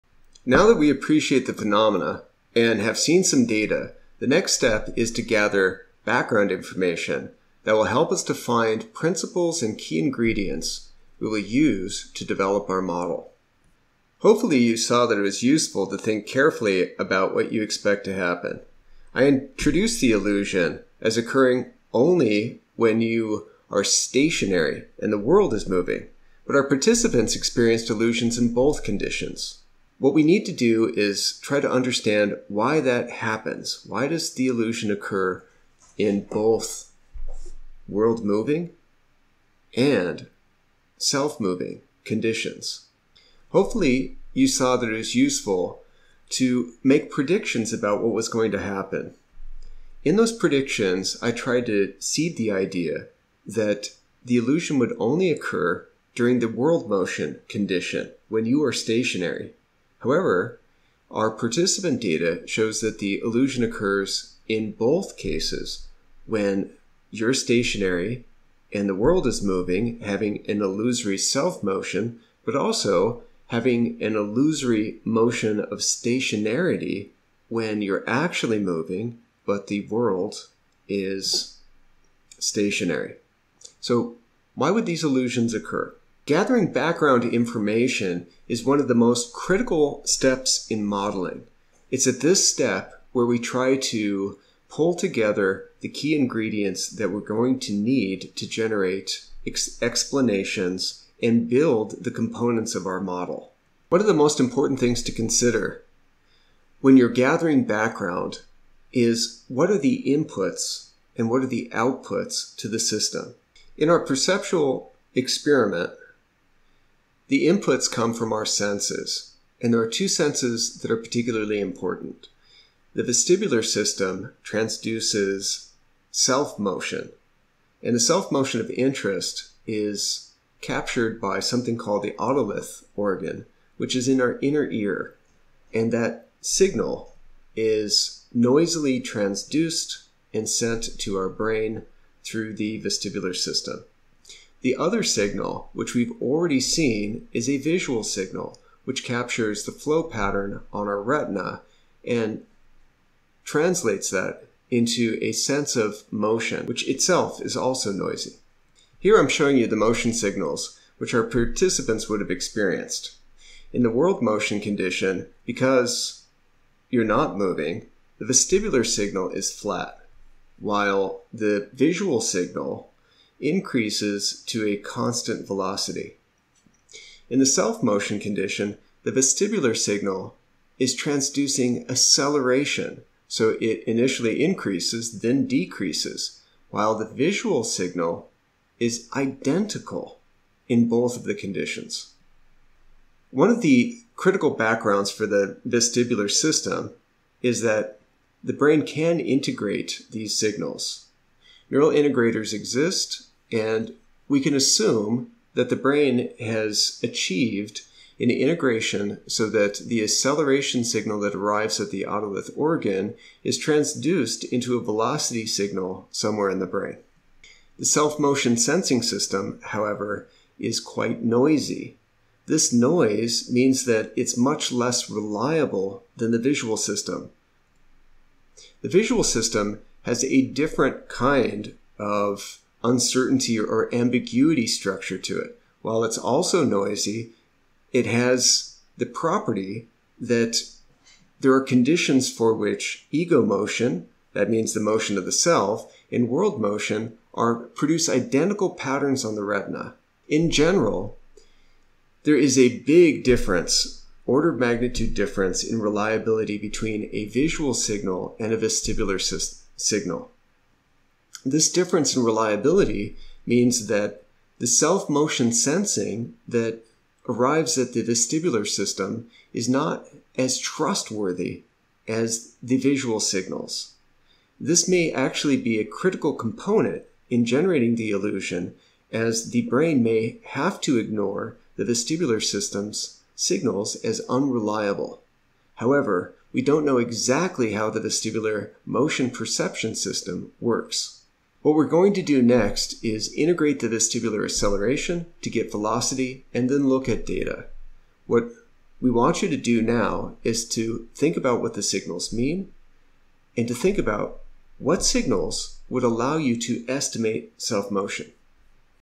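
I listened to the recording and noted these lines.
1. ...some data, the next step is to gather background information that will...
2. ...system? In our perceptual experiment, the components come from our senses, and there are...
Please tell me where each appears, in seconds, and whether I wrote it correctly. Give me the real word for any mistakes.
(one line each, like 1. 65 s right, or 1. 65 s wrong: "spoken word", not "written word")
1. 3 s right
2. 112 s wrong: "inputs", not "components".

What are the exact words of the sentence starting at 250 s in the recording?
In general, there is a big difference, order of magnitude difference in reliability between a visual signal and a vestibular signal.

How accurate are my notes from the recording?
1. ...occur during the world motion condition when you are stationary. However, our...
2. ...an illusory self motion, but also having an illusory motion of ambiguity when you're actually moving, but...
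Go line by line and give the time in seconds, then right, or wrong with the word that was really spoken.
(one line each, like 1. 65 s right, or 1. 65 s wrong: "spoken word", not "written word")
1. 55 s right
2. 70 s wrong: "stationarity", not "ambiguity".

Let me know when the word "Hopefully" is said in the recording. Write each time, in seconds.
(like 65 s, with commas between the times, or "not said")
14 s, 43 s.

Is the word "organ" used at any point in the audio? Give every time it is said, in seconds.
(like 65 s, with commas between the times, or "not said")
132 s, 212 s.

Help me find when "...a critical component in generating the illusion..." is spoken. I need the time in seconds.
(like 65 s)
275 s.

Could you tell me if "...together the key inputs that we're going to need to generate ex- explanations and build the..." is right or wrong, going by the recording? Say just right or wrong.
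wrong.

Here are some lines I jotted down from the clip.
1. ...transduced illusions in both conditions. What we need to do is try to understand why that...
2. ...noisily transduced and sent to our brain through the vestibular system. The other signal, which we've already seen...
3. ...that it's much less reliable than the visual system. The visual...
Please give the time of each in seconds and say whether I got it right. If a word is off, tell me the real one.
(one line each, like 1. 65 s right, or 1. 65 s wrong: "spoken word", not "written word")
1. 27 s wrong: "experienced", not "transduced"
2. 138 s right
3. 223 s right.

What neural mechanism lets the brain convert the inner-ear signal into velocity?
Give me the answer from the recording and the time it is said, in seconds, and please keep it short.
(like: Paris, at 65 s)
Neural integrators, at 201 s.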